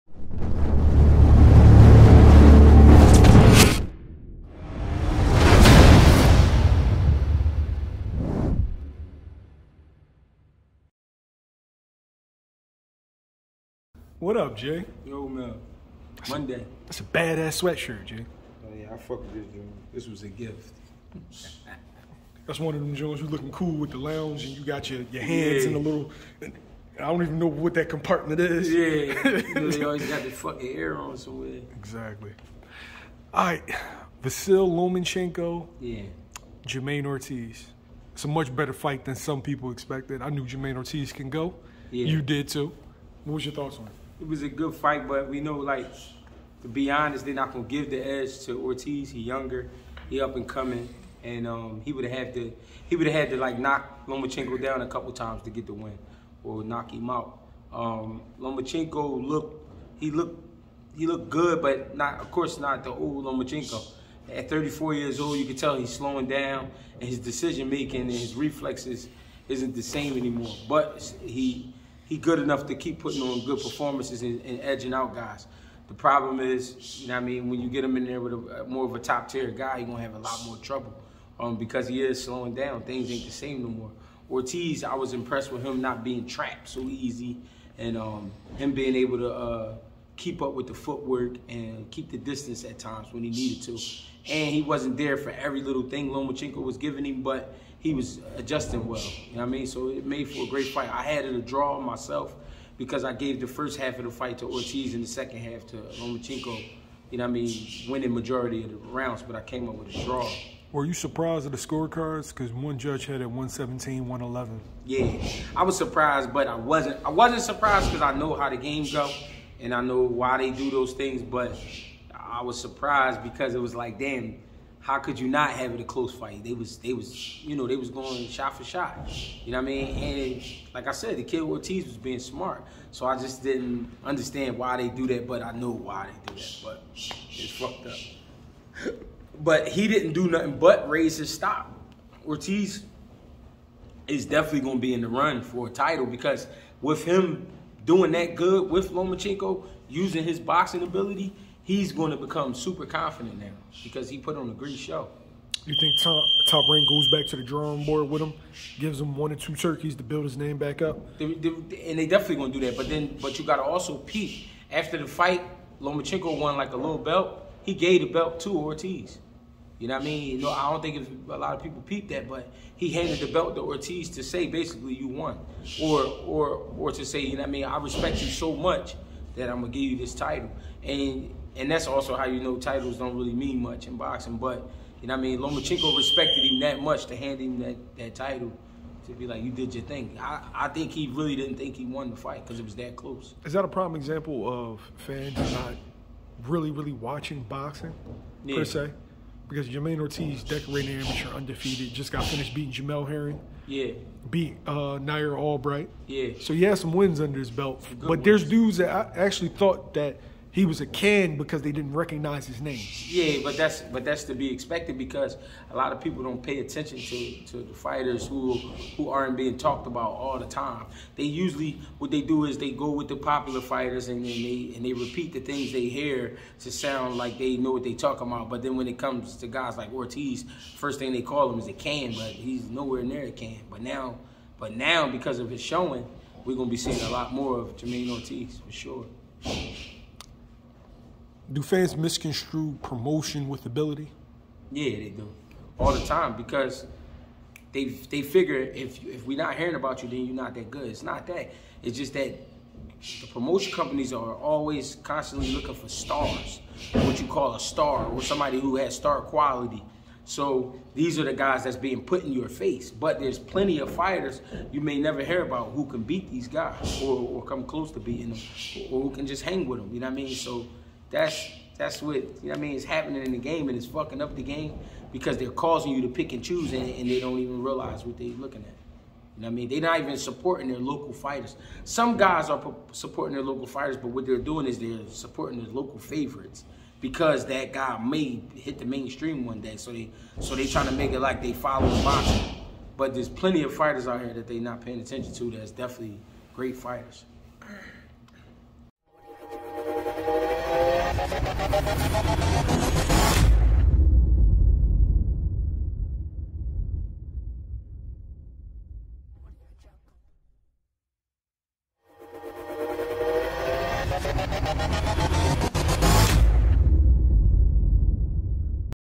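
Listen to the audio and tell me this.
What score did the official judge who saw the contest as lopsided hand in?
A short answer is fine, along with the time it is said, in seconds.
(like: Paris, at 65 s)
117-111, at 113 s.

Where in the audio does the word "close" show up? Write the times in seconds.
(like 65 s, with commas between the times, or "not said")
125 s, 192 s, 267 s.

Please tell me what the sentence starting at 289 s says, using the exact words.
So they so they trying to make it like they follow the boxing.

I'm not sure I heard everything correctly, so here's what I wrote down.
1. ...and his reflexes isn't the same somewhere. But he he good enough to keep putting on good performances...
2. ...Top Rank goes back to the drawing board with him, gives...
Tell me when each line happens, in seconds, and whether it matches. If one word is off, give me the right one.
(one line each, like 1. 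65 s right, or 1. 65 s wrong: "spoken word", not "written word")
1. 68 s wrong: "anymore", not "somewhere"
2. 156 s right.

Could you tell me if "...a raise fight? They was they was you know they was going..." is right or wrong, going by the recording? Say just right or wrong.
wrong.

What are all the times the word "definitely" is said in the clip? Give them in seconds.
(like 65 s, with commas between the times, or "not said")
144 s, 162 s, 295 s.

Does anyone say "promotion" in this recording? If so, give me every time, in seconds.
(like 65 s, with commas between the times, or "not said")
242 s, 253 s.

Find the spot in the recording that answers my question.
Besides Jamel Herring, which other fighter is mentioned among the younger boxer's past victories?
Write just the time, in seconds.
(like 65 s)
204 s.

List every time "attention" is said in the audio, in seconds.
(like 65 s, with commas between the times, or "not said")
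216 s, 295 s.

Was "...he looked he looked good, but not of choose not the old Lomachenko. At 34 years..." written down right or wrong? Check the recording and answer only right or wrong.
wrong.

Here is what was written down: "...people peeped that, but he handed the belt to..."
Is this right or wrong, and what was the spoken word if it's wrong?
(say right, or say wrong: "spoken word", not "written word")
right.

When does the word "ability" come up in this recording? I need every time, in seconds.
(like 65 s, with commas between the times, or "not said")
150 s, 243 s.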